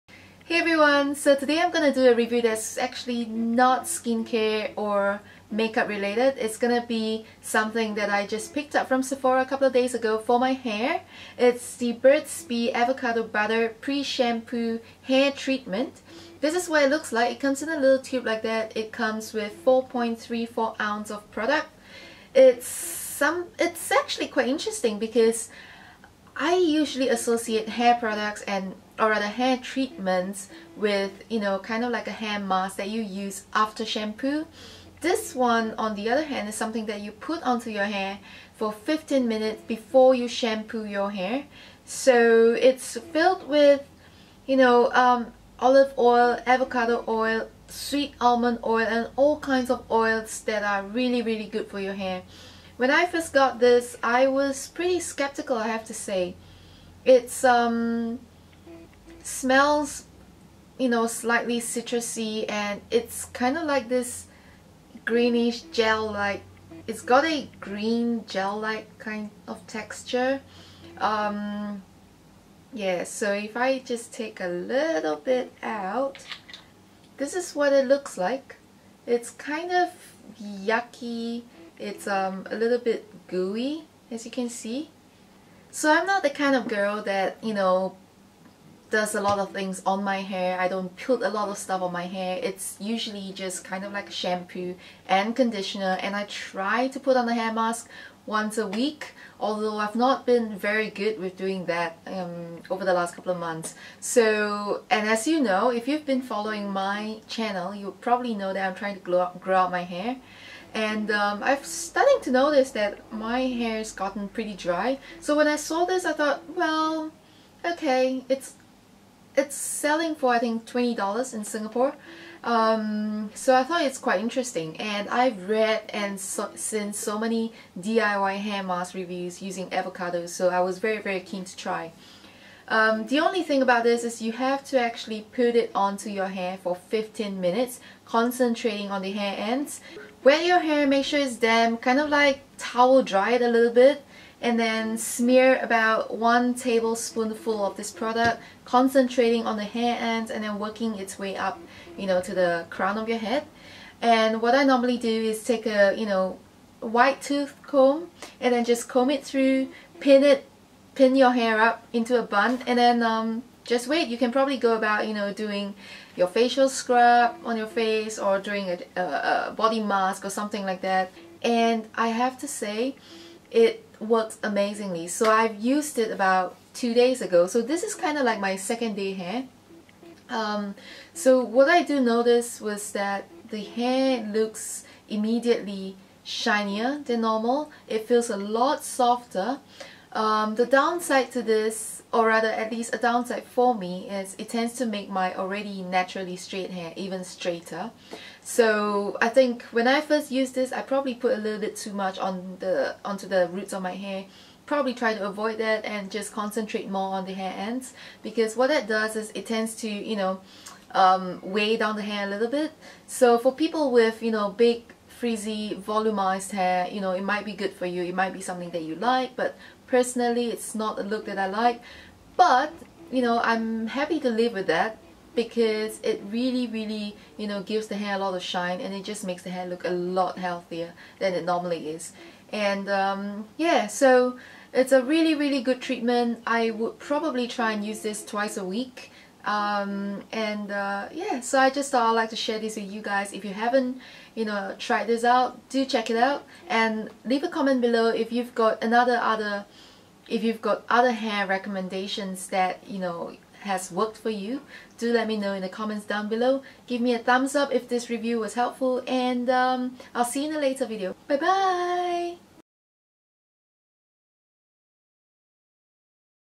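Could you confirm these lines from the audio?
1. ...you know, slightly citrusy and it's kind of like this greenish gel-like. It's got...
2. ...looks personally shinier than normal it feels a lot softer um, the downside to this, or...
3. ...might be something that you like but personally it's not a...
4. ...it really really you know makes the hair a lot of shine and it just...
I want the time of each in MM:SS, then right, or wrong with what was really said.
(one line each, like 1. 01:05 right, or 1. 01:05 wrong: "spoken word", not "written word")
1. 01:00 right
2. 03:04 wrong: "immediately", not "personally"
3. 03:38 right
4. 03:46 wrong: "gives", not "makes".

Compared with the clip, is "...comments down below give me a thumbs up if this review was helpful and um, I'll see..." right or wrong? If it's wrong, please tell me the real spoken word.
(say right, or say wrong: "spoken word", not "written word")
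right.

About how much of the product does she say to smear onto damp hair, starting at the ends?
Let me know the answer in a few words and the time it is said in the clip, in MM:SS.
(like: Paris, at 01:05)
one tablespoonful, at 02:26.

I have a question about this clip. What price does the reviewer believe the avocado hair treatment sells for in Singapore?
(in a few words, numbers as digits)
$20.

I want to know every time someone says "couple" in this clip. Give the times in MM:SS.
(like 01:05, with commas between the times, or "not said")
00:09, 01:43.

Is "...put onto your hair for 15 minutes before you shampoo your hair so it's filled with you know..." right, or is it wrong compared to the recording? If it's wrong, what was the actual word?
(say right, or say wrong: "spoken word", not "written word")
right.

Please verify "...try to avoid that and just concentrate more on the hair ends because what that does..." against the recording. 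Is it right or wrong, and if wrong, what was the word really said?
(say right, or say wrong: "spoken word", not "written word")
right.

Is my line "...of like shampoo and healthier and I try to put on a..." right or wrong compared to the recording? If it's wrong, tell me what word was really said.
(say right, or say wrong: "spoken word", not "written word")
wrong: "conditioner", not "healthier".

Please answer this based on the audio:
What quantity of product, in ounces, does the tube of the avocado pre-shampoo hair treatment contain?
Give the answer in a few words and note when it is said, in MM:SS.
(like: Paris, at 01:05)
4.34 ounce, at 00:19.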